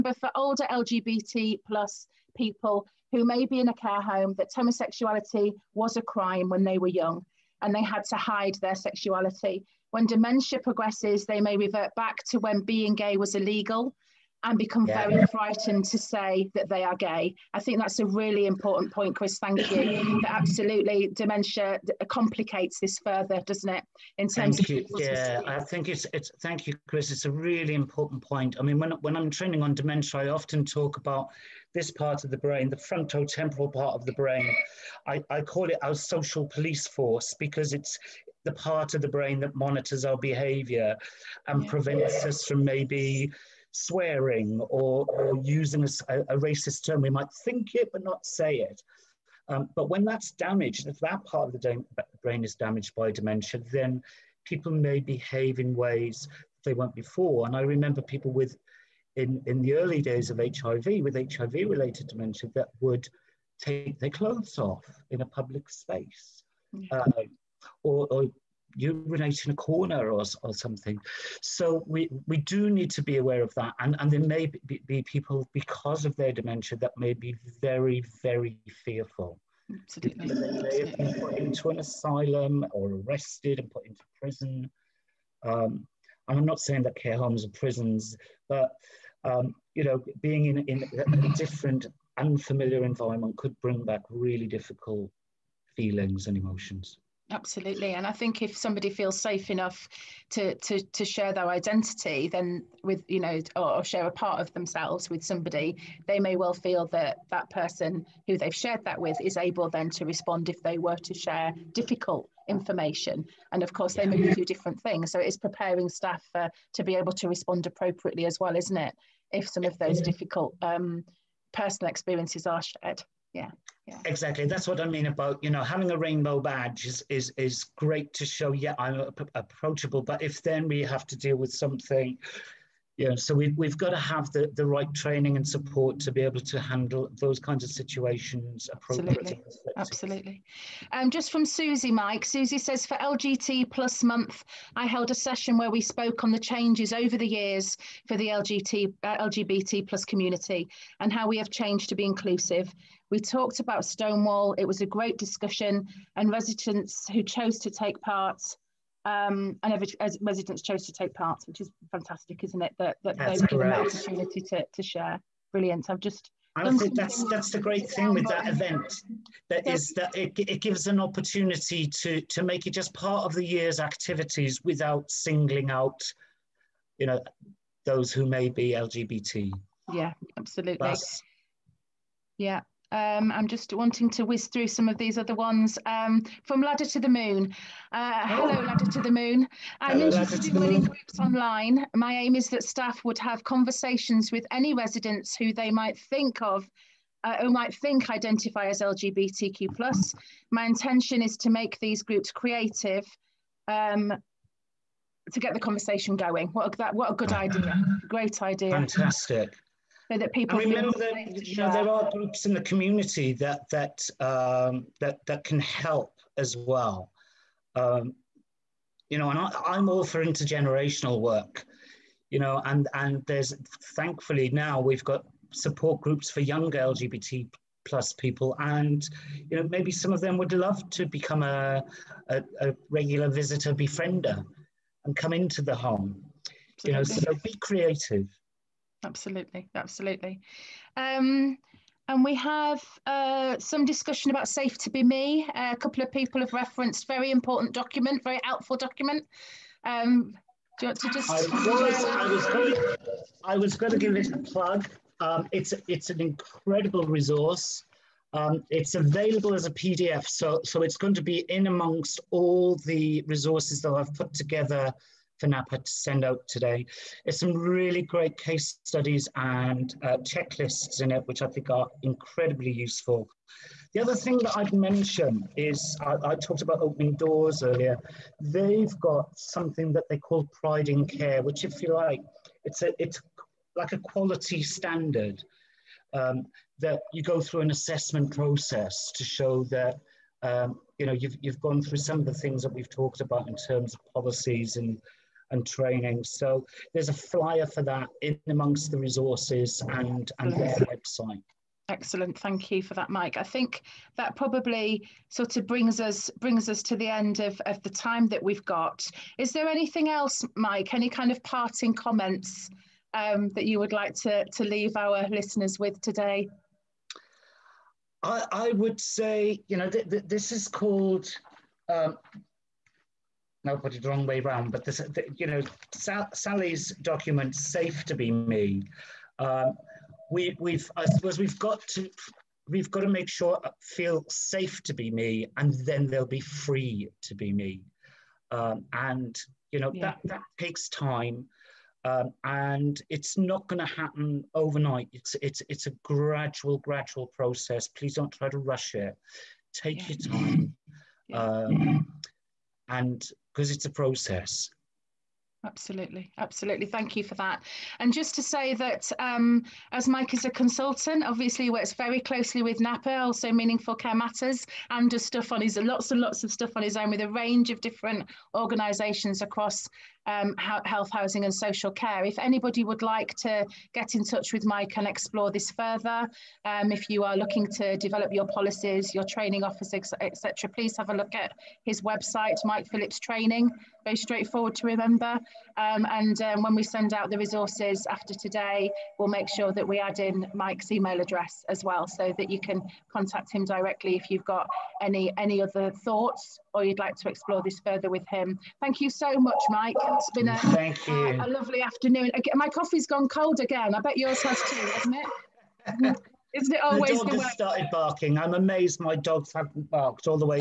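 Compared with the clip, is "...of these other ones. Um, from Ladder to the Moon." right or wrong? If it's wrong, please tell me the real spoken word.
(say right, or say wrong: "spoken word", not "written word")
right.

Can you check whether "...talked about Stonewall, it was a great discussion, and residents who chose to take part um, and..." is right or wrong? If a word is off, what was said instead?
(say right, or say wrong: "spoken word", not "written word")
right.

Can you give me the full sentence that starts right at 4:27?
There's some really great case studies and uh, checklists in it, which I think are incredibly useful.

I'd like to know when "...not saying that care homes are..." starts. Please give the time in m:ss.
1:26.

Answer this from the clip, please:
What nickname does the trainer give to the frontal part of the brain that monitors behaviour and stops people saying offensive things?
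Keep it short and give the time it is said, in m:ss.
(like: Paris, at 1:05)
social police force, at 0:35.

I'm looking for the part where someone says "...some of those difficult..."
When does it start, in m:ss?
1:59.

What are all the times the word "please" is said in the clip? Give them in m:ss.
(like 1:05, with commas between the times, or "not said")
5:47, 6:20.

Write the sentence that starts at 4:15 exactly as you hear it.
Um, it's, it's an incredible resource.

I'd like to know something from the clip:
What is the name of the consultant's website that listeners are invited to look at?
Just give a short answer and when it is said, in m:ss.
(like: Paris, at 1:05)
Mike Phillips Training, at 6:22.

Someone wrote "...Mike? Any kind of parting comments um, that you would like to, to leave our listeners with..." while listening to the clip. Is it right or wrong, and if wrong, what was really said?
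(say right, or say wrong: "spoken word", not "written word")
right.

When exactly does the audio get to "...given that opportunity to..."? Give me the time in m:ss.
2:43.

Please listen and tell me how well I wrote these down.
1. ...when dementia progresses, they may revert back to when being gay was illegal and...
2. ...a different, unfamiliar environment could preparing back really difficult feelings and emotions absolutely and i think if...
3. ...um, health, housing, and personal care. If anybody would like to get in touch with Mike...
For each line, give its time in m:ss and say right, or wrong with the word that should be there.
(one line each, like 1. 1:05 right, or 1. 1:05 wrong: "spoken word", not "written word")
1. 0:09 right
2. 1:31 wrong: "bring", not "preparing"
3. 6:10 wrong: "social", not "personal".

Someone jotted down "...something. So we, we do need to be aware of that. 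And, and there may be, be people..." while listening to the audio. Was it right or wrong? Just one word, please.
right.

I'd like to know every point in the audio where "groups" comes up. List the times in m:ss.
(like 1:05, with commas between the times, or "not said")
3:10, 3:22, 3:32, 3:46.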